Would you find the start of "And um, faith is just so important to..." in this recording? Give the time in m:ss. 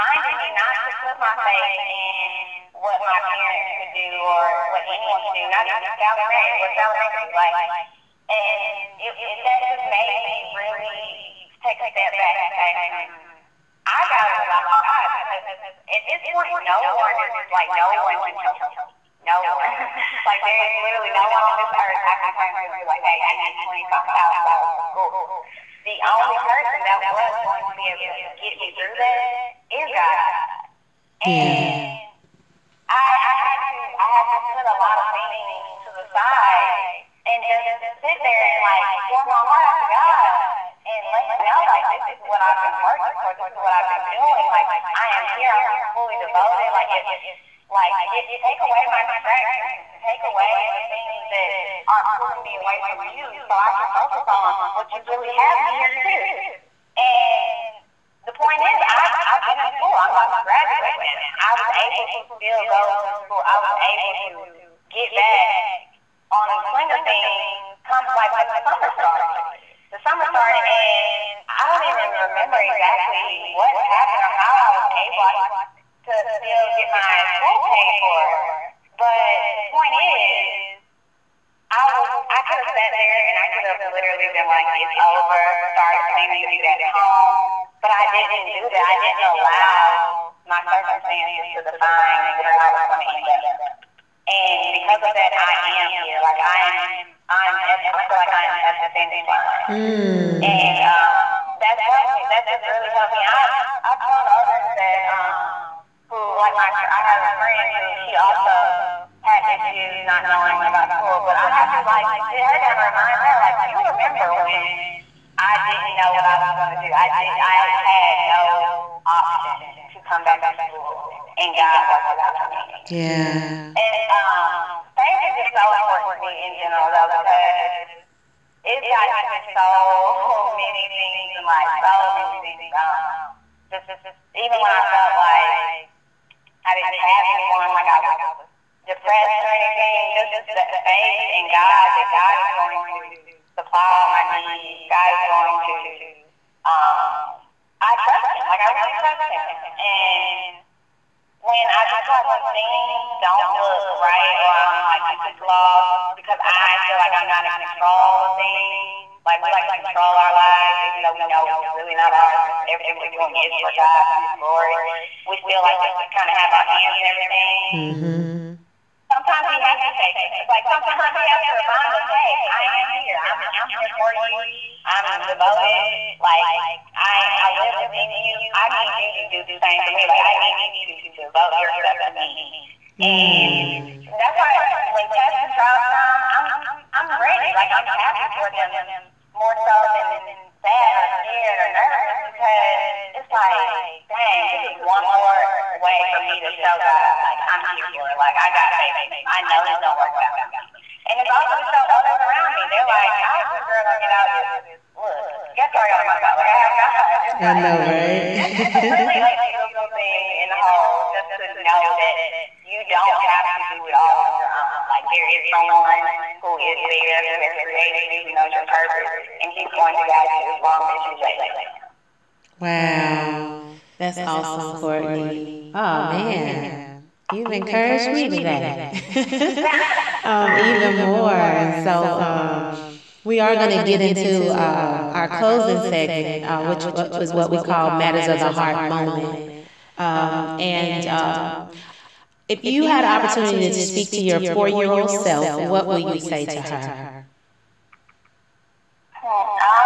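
2:03.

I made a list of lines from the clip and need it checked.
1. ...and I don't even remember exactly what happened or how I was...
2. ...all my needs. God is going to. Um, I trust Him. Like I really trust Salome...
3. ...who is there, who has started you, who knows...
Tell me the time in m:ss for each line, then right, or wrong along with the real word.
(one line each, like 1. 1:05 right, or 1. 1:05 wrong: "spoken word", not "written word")
1. 1:10 right
2. 2:24 wrong: "Him", not "Salome"
3. 3:36 wrong: "created", not "started".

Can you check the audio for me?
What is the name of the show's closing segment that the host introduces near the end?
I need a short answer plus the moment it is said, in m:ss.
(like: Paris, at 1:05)
Matters of the Heart moment, at 3:57.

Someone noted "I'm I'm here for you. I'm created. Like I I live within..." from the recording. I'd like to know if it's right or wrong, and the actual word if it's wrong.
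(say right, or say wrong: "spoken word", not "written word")
wrong: "devoted", not "created".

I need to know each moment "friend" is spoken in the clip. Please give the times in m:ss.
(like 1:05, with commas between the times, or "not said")
1:47.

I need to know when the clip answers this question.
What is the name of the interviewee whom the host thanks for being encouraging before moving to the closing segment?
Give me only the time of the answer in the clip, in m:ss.
3:44.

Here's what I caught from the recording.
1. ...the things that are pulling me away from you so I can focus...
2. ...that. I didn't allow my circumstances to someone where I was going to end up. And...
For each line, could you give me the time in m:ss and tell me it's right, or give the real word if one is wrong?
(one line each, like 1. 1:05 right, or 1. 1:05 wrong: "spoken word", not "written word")
1. 0:50 right
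2. 1:28 wrong: "define", not "someone".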